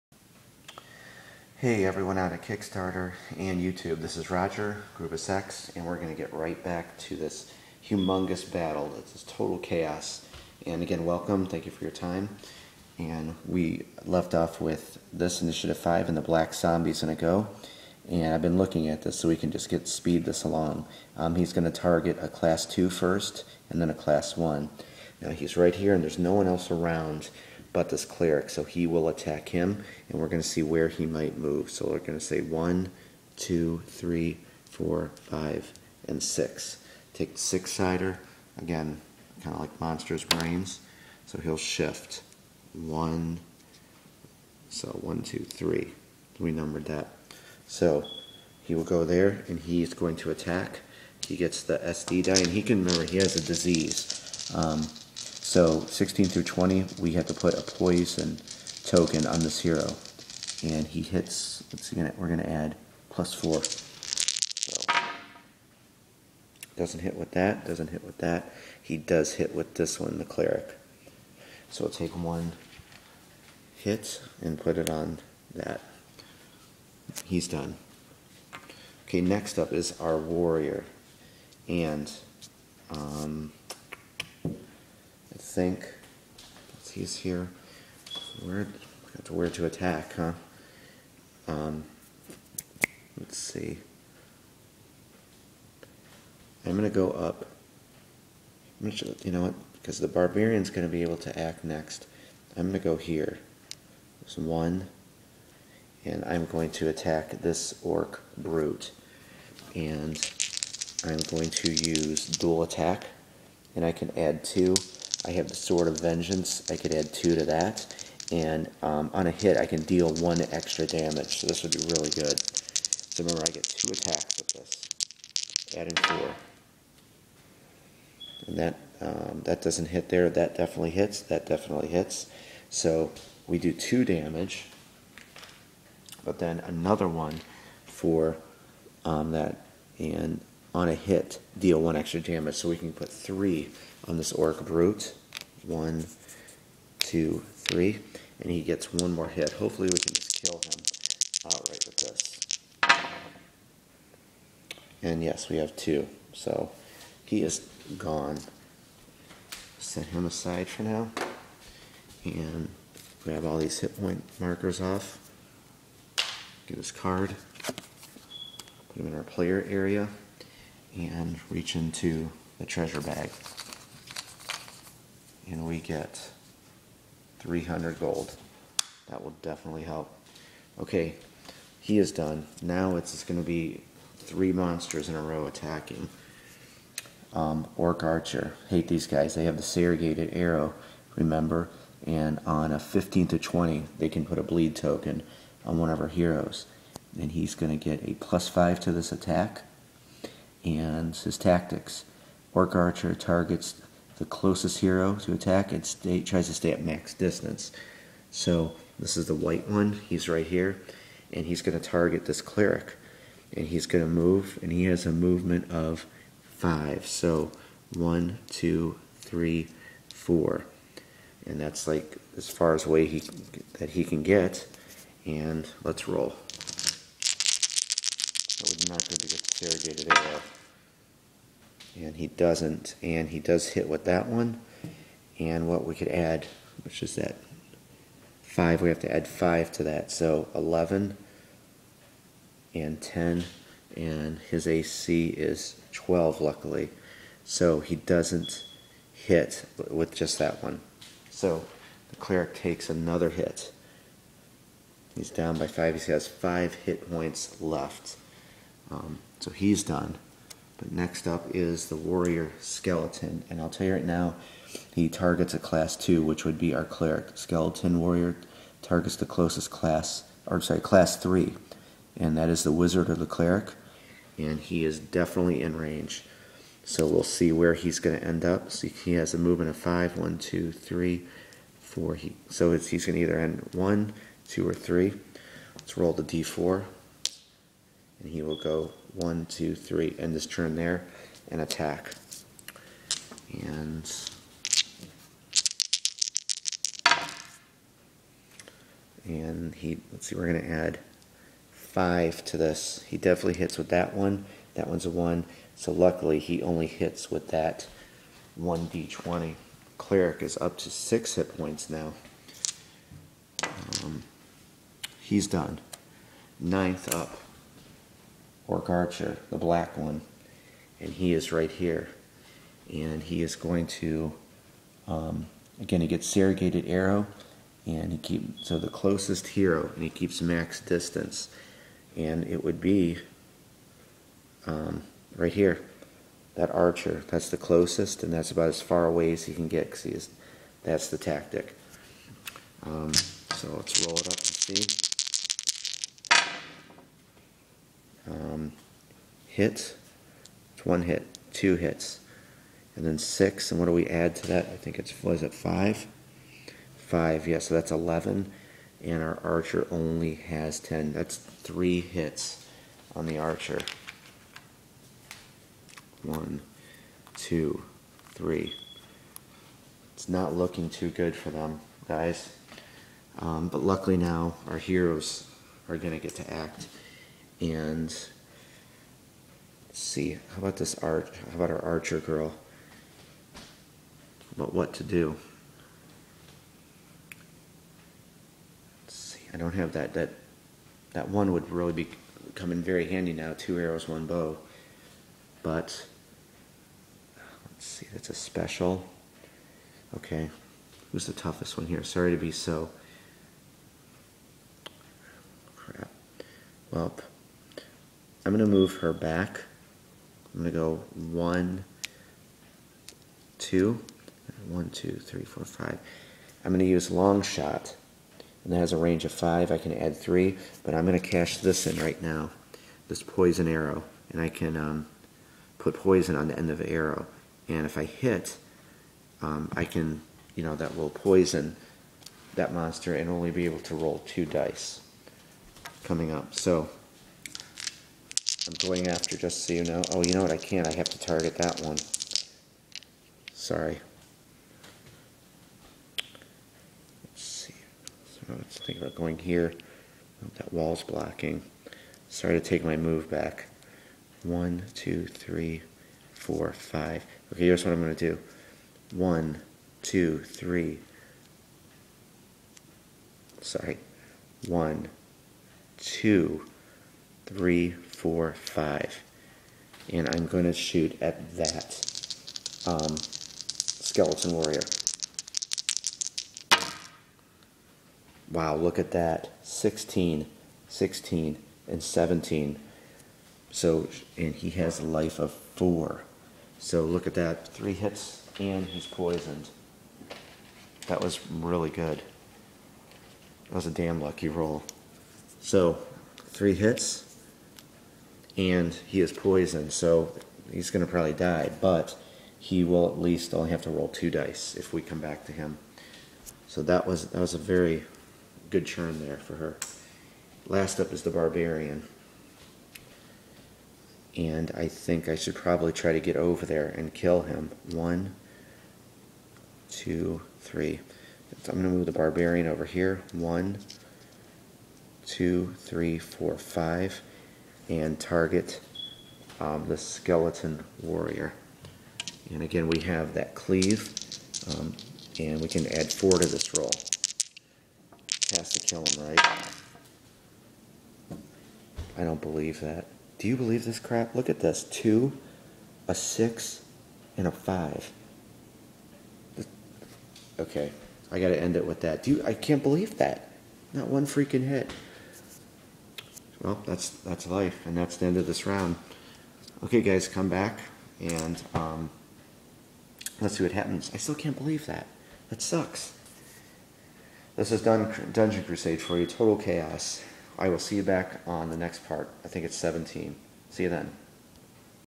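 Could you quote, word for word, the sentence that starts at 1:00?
And he hits, let's see, we're going to add plus 4.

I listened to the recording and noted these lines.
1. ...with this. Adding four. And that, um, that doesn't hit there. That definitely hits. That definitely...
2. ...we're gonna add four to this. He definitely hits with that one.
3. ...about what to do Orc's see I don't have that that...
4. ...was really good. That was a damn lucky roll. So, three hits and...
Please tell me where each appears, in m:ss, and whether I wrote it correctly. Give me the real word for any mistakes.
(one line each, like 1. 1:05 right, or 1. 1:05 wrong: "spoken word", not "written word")
1. 2:04 right
2. 5:00 wrong: "five", not "four"
3. 6:24 wrong: "Let", not "Orc"
4. 8:11 right.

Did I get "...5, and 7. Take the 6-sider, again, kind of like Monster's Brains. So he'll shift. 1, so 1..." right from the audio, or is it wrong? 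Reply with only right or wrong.
wrong.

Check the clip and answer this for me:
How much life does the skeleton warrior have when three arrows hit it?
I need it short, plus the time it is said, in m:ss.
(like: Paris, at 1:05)
4, at 8:04.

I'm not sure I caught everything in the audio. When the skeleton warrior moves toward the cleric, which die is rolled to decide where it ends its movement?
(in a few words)
d4.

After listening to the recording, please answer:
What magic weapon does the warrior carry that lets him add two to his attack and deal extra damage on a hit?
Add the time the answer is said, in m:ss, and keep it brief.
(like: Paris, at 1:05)
Sword of Vengeance, at 1:55.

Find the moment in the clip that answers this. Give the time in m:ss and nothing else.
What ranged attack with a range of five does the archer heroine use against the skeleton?
6:57.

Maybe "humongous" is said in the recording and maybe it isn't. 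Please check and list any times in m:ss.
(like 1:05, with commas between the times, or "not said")
0:07.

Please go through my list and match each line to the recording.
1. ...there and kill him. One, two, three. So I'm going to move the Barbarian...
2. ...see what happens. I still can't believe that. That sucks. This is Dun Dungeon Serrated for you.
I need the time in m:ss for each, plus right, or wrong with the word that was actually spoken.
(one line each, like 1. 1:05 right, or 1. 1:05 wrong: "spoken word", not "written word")
1. 8:36 right
2. 9:23 wrong: "Crusade", not "Serrated".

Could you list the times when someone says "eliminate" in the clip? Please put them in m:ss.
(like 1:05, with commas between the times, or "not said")
not said.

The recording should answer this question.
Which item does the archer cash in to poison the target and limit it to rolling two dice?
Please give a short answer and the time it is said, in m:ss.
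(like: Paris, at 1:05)
Poison arrow, at 7:03.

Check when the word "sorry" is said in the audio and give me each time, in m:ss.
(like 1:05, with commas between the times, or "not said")
4:30, 6:42, 7:23, 7:32, 7:43.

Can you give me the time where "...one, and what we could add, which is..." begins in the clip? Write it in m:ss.
3:54.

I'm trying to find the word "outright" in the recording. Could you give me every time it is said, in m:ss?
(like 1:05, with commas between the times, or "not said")
2:31.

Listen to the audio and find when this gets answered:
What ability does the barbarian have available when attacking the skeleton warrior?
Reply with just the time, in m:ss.
8:53.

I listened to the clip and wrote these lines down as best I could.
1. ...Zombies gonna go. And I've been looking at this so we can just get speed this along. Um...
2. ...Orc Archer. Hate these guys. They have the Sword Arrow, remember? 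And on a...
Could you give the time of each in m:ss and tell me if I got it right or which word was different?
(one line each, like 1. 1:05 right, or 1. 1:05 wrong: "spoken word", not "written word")
1. 0:16 right
2. 3:07 wrong: "Serrated", not "Sword".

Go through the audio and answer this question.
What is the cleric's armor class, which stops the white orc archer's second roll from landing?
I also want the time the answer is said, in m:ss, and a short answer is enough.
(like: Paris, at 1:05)
12, at 4:05.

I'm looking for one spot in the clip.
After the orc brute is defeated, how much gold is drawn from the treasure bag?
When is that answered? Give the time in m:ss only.
2:57.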